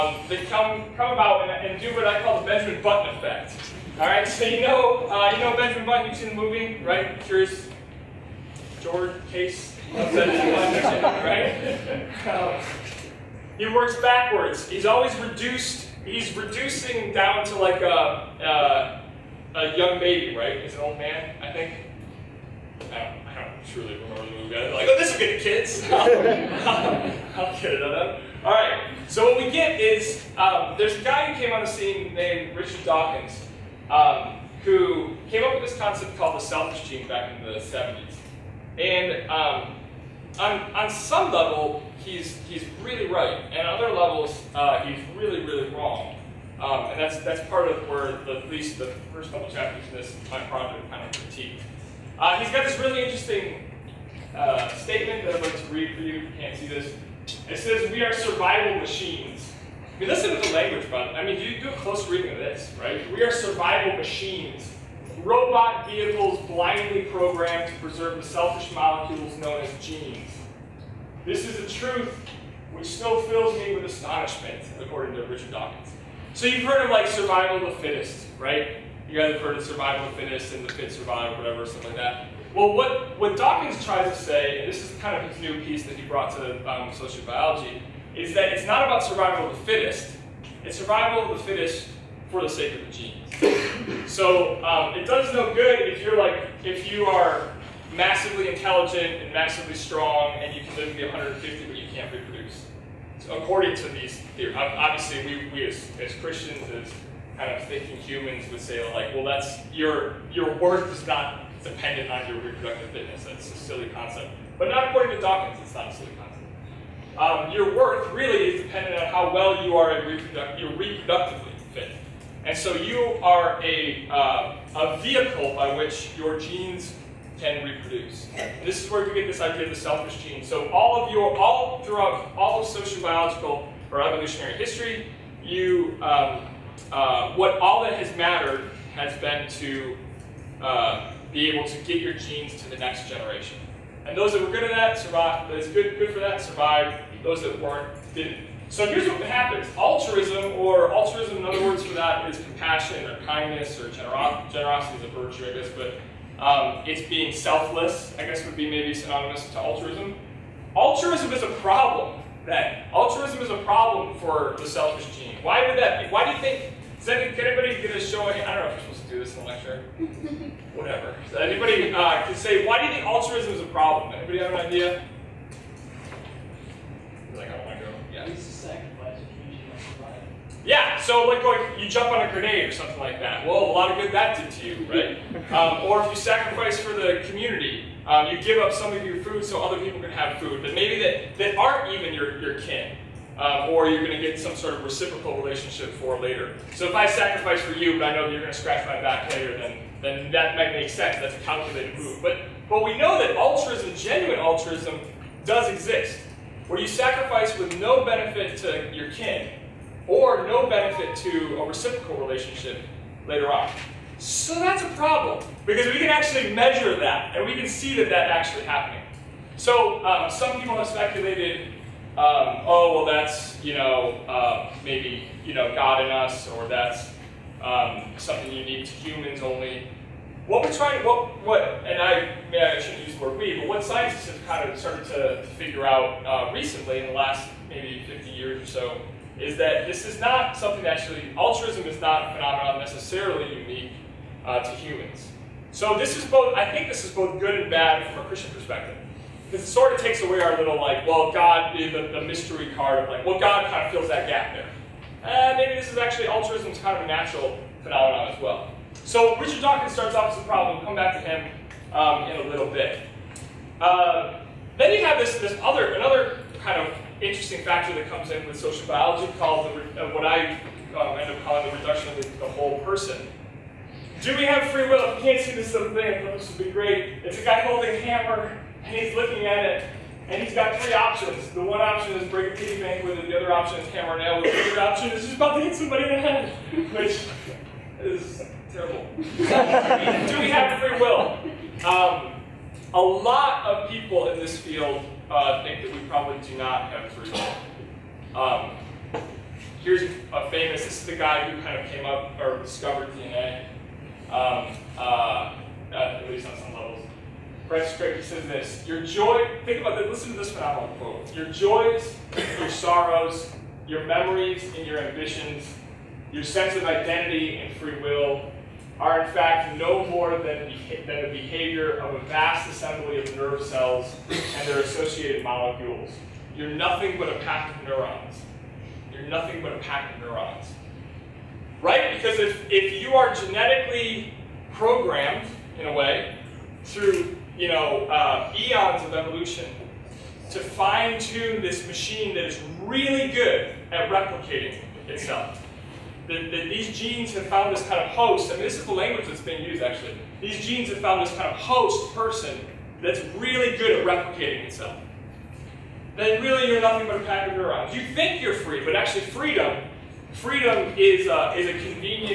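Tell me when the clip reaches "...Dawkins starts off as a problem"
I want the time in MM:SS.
04:19.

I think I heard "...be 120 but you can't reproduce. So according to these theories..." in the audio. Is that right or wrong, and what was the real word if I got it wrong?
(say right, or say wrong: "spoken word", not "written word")
wrong: "150", not "120".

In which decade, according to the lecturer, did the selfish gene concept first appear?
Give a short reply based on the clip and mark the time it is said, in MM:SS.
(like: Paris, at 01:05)
the 70s, at 00:37.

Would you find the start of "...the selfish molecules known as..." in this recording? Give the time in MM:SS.
01:08.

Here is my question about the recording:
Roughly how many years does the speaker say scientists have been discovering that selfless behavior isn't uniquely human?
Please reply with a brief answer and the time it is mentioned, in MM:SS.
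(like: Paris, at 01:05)
50, at 03:58.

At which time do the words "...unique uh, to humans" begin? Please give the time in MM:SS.
04:03.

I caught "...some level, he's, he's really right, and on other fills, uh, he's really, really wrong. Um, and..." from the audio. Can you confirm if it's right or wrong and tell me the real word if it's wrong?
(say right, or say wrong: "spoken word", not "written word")
wrong: "levels", not "fills".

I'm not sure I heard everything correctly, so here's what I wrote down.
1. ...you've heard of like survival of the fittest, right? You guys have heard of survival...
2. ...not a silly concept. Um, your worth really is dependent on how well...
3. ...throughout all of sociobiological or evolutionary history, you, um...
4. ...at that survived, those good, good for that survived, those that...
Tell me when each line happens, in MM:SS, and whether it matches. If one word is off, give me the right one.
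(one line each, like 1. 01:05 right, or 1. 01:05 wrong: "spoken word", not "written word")
1. 01:16 right
2. 01:55 right
3. 02:11 right
4. 02:24 right.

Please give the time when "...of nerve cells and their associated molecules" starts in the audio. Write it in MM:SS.
05:23.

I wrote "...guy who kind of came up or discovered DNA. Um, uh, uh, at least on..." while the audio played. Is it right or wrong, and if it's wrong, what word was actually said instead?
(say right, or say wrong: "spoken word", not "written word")
right.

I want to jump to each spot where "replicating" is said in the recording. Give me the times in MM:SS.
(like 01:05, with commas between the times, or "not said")
05:44, 05:54.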